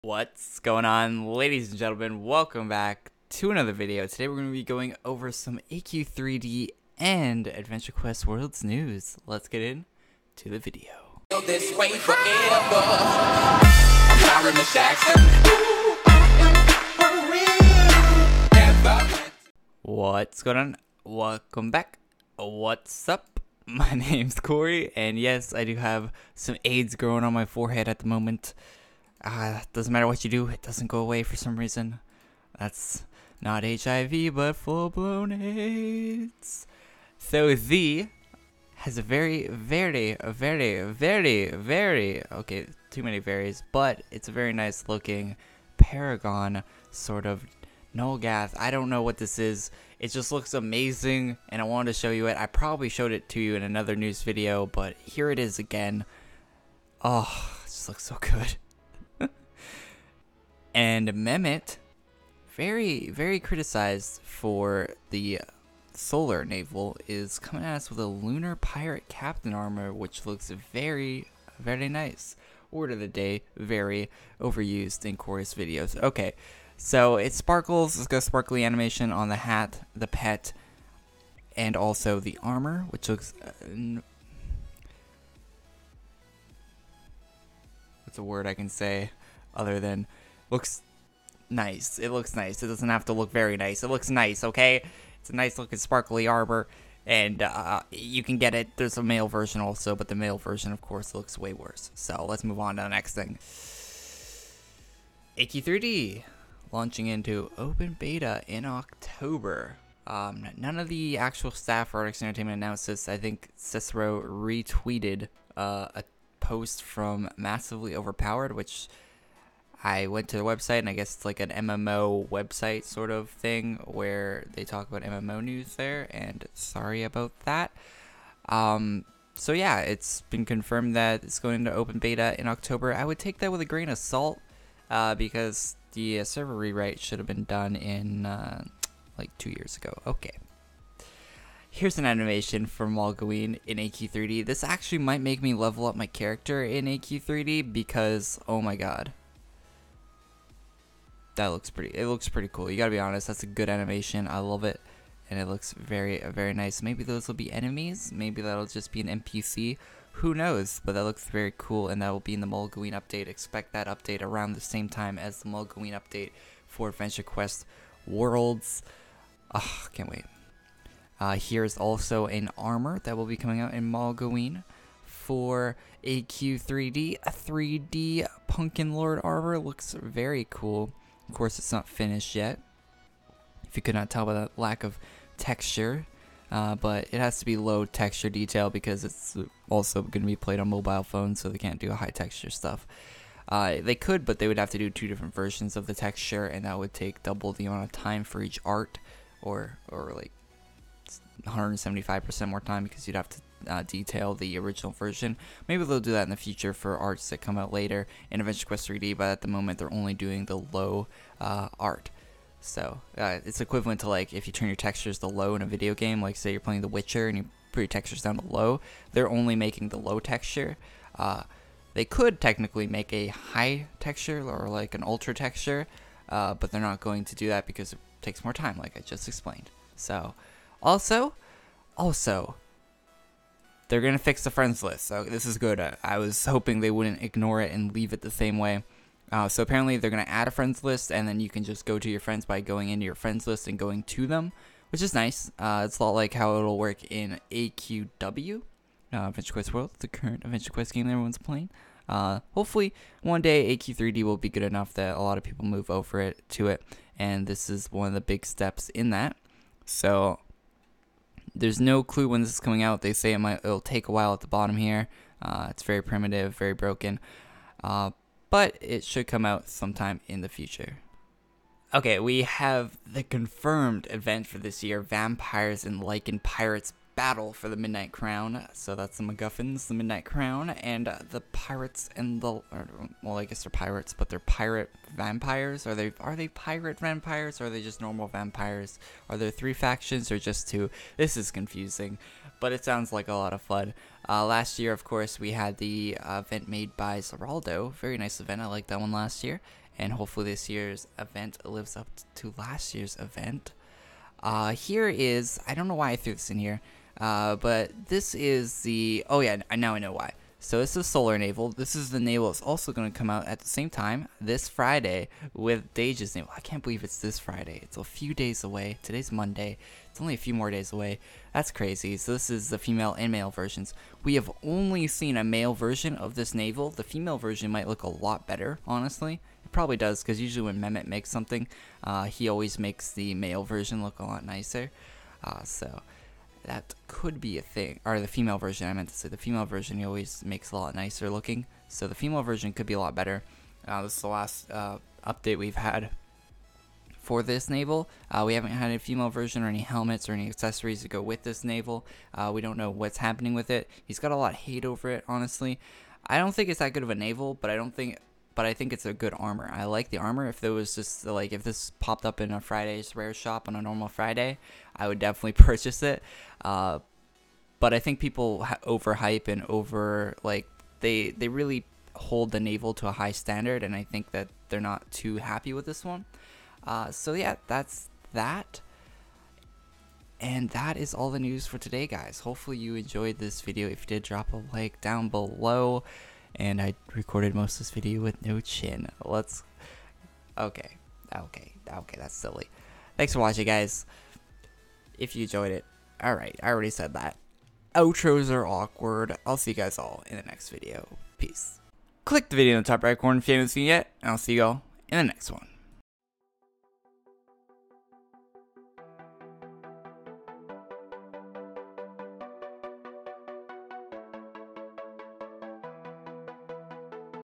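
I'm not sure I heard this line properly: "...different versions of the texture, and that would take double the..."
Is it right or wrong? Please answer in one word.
right.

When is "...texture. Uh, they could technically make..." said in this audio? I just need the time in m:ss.
3:40.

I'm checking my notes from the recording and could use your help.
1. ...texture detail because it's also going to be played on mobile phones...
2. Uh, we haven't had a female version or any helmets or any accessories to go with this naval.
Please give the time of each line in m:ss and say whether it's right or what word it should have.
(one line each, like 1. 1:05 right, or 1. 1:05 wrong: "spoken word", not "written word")
1. 3:07 right
2. 5:48 right.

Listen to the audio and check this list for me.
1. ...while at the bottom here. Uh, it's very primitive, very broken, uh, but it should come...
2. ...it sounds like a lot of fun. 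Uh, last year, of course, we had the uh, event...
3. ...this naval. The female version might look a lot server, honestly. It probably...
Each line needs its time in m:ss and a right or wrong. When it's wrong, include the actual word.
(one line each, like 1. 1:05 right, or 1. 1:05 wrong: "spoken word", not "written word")
1. 4:24 right
2. 4:52 right
3. 5:26 wrong: "better", not "server".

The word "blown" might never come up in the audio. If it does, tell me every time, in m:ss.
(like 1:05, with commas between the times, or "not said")
0:34.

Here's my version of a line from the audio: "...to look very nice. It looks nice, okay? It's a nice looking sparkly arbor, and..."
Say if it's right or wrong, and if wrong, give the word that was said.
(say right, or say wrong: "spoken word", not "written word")
right.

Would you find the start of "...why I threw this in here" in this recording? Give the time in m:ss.
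5:05.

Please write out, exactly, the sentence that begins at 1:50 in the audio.
Um, none of the actual staff or Artix Entertainment announced this.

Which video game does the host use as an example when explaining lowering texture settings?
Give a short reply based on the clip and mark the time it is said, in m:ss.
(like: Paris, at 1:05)
The Witcher, at 3:36.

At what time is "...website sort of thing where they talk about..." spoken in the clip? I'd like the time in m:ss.
2:02.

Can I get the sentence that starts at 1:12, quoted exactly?
Word of the day, very overused in Korey's videos.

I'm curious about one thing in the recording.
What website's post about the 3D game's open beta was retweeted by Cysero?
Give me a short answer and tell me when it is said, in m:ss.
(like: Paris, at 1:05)
Massively Overpowered, at 1:57.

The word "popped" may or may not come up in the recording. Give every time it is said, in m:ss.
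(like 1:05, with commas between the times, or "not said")
6:01.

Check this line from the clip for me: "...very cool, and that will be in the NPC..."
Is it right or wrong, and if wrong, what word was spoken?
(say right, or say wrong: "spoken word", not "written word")
wrong: "Mogloween", not "NPC".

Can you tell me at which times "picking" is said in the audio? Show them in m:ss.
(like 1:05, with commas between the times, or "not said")
not said.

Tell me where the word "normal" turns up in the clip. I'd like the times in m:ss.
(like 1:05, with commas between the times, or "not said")
4:48, 6:03.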